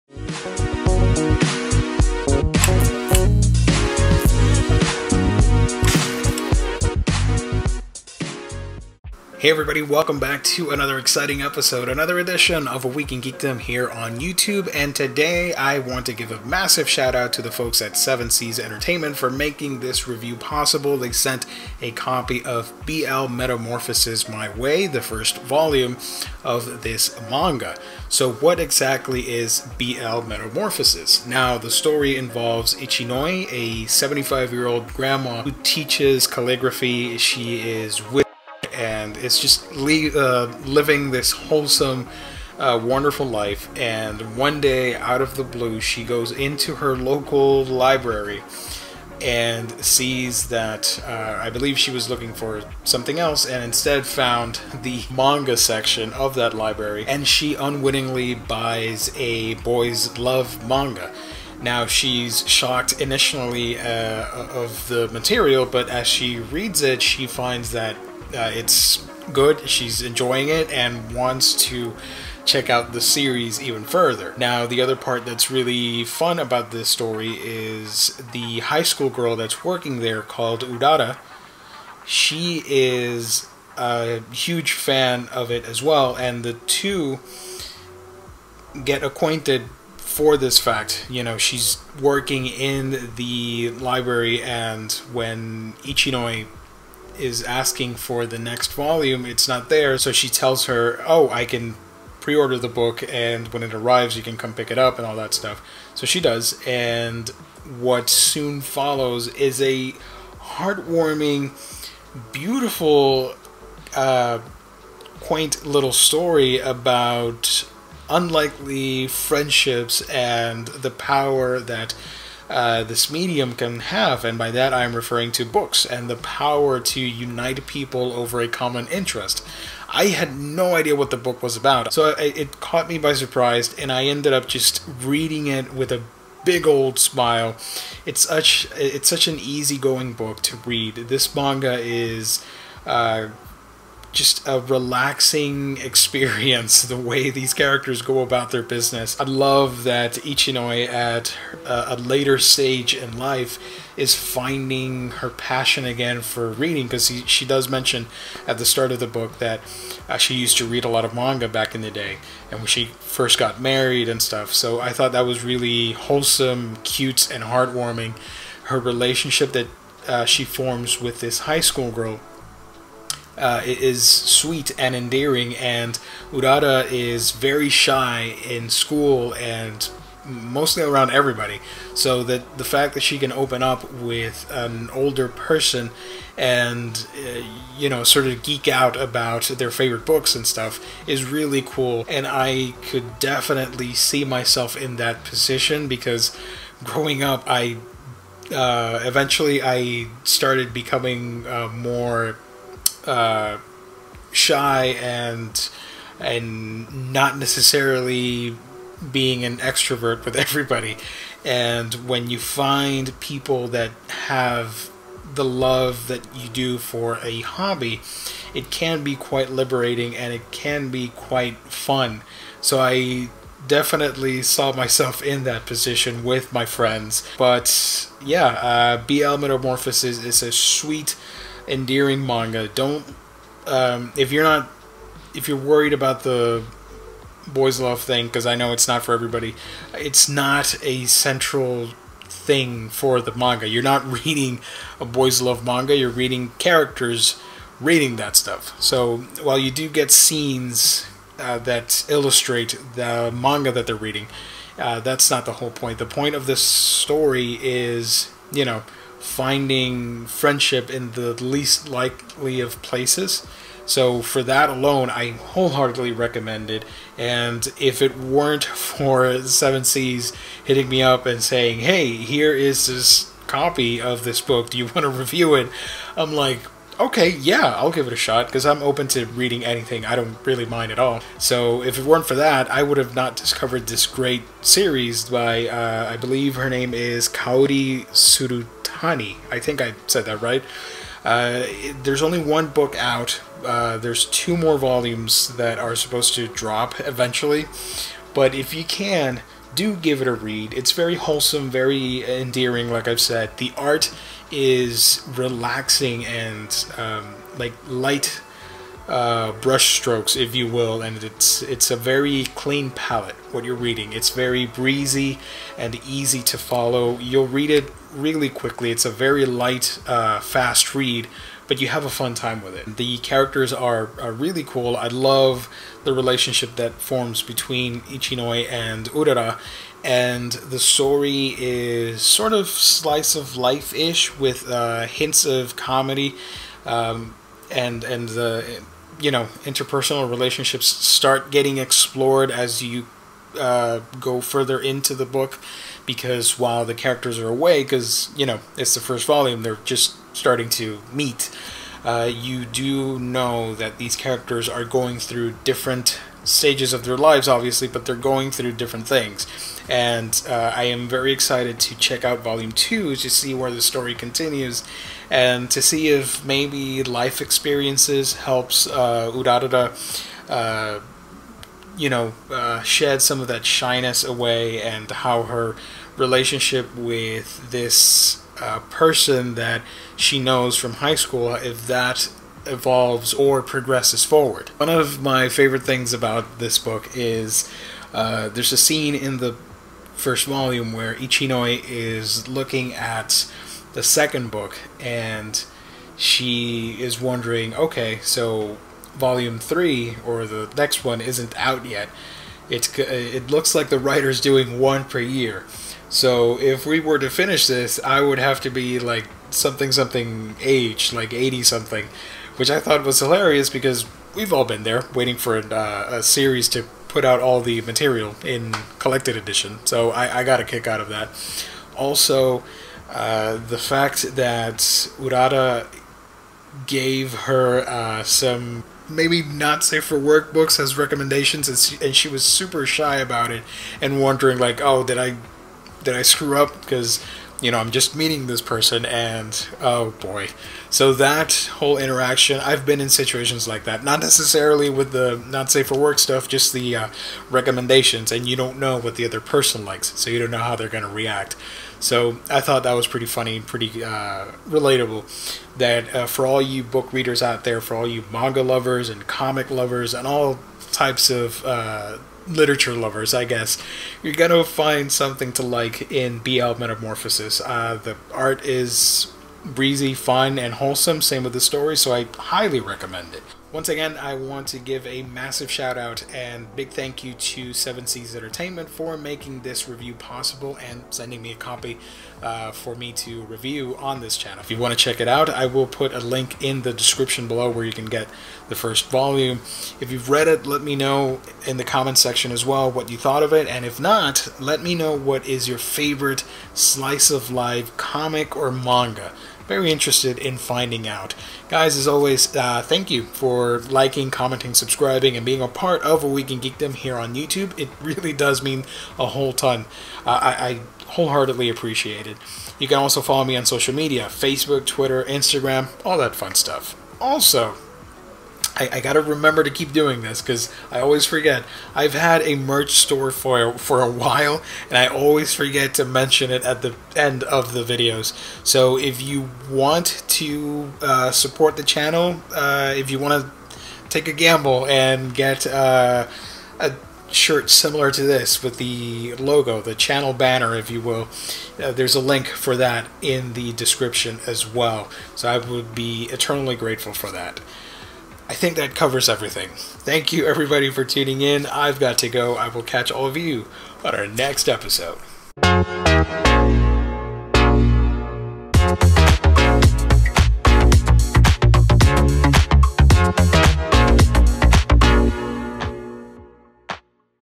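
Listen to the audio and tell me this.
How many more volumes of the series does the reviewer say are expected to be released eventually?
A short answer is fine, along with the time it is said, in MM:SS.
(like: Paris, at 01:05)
2, at 04:54.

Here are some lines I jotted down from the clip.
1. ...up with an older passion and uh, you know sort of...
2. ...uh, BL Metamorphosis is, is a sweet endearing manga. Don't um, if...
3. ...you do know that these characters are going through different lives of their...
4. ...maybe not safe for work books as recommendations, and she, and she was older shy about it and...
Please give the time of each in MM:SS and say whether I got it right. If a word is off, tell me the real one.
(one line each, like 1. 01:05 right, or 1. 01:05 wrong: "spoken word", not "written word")
1. 03:03 wrong: "person", not "passion"
2. 03:48 right
3. 05:52 wrong: "stages", not "lives"
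4. 07:09 wrong: "super", not "older".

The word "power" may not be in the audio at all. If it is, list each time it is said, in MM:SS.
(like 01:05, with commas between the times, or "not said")
02:00, 02:06.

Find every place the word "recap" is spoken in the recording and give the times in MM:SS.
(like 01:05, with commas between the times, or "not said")
not said.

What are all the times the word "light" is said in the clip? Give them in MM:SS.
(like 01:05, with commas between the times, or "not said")
05:07, 05:19.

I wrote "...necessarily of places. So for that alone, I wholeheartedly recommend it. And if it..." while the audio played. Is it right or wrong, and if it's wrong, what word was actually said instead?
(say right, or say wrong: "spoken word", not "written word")
wrong: "likely", not "necessarily".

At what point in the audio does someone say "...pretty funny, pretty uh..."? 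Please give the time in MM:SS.
07:33.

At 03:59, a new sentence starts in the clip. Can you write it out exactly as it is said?
It's not a central thing for the manga.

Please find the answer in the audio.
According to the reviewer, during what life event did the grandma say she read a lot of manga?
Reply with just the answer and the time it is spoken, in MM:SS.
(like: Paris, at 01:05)
When she first got married, at 02:42.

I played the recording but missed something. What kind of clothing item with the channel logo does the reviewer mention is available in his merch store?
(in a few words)
A shirt.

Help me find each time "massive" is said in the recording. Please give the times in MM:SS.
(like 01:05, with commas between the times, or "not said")
00:16, 07:55.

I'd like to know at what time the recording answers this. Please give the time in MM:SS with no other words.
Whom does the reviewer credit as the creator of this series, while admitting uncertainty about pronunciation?
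04:47.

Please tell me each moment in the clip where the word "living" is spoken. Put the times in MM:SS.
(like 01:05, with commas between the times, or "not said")
00:40.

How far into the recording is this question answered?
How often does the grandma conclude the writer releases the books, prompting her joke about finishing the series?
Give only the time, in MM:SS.
06:44.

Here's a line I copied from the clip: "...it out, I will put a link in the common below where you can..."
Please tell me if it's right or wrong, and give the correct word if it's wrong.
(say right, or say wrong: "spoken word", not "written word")
wrong: "description", not "common".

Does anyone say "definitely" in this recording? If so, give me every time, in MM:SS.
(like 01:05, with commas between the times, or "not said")
03:13, 03:43.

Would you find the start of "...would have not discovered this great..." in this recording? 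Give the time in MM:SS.
04:42.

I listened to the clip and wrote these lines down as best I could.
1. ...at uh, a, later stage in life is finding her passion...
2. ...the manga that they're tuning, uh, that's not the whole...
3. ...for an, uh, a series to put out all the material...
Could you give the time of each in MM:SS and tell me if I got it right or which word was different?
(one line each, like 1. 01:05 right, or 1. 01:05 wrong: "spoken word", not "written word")
1. 02:30 right
2. 04:12 wrong: "reading", not "tuning"
3. 06:55 right.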